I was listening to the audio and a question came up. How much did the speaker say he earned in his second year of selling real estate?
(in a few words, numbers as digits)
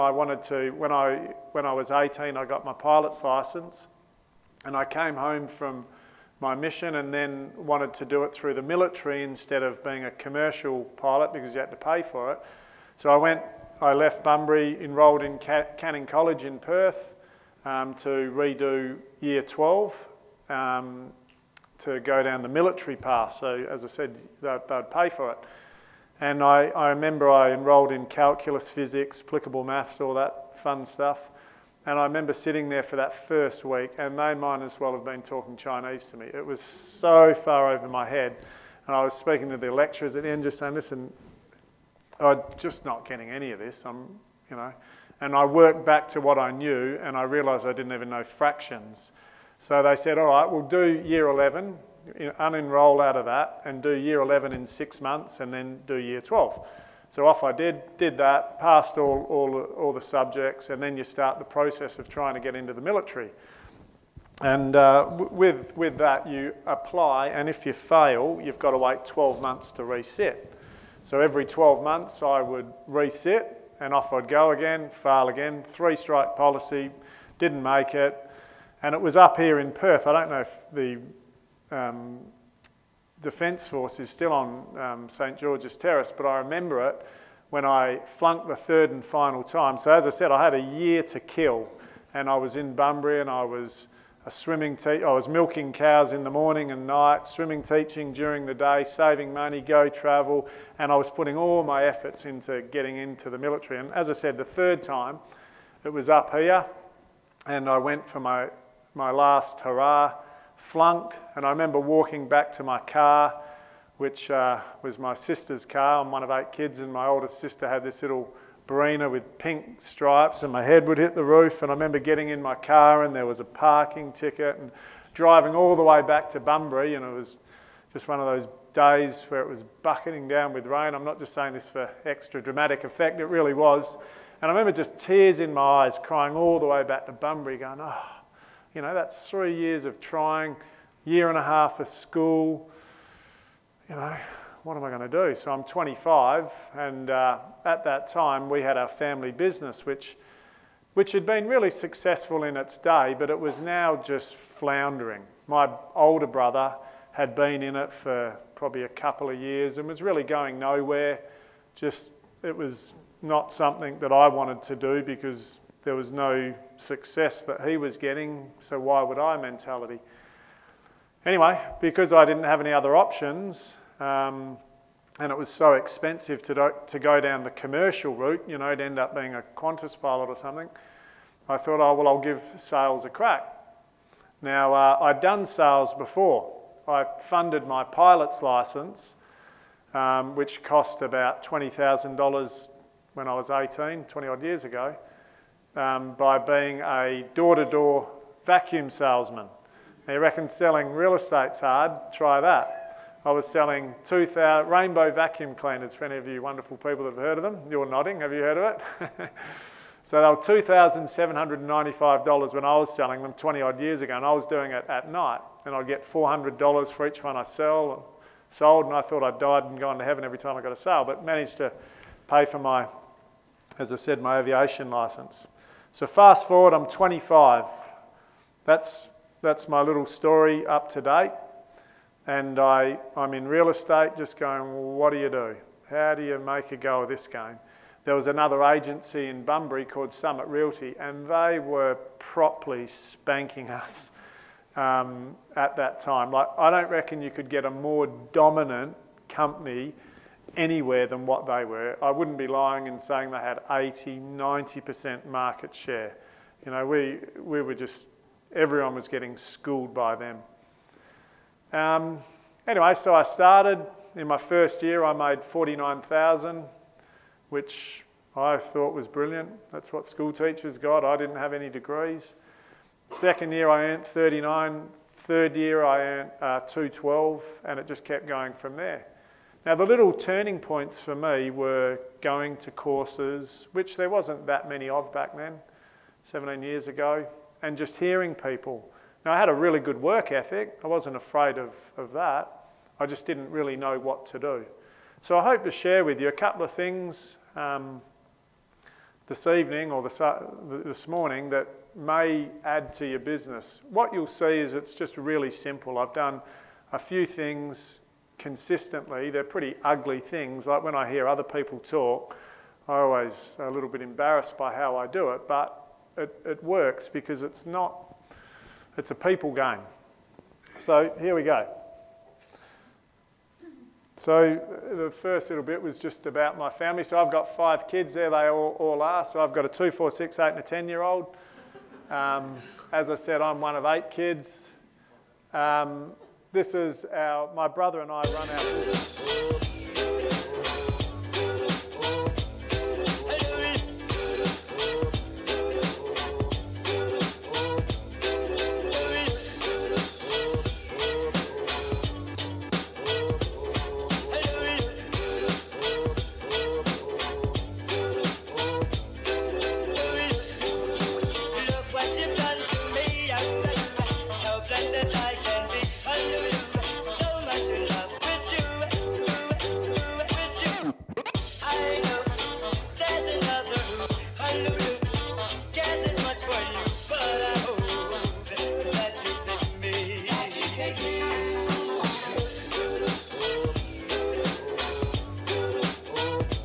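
39,000.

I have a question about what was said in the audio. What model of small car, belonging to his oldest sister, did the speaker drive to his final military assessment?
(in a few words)
Barina.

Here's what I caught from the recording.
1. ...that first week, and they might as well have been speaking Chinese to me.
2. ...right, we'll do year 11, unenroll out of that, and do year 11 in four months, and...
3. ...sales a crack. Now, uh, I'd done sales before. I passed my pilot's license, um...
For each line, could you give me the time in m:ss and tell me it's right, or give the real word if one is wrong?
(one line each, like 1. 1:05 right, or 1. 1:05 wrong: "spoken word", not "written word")
1. 0:32 wrong: "talking", not "speaking"
2. 0:50 wrong: "six", not "four"
3. 3:02 wrong: "funded", not "passed".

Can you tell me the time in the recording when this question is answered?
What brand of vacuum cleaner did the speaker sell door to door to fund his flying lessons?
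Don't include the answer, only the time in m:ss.
3:24.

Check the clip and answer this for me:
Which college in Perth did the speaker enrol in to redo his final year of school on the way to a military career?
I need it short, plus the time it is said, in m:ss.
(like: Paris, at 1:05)
Canning College, at 0:15.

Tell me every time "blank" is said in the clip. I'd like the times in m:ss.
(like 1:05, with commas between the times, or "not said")
not said.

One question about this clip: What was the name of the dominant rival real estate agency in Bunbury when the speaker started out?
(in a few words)
Summit Realty.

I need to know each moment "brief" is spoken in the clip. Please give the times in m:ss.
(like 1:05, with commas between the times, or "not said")
not said.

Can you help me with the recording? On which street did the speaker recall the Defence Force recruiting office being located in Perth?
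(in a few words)
St George's Terrace.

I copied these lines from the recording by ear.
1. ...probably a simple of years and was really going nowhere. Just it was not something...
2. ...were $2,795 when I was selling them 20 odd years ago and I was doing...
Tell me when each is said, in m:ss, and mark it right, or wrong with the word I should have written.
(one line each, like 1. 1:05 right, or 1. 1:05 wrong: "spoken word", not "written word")
1. 2:38 wrong: "couple", not "simple"
2. 3:30 right.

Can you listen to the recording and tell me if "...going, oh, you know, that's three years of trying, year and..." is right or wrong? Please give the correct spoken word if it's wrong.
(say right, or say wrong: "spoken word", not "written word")
right.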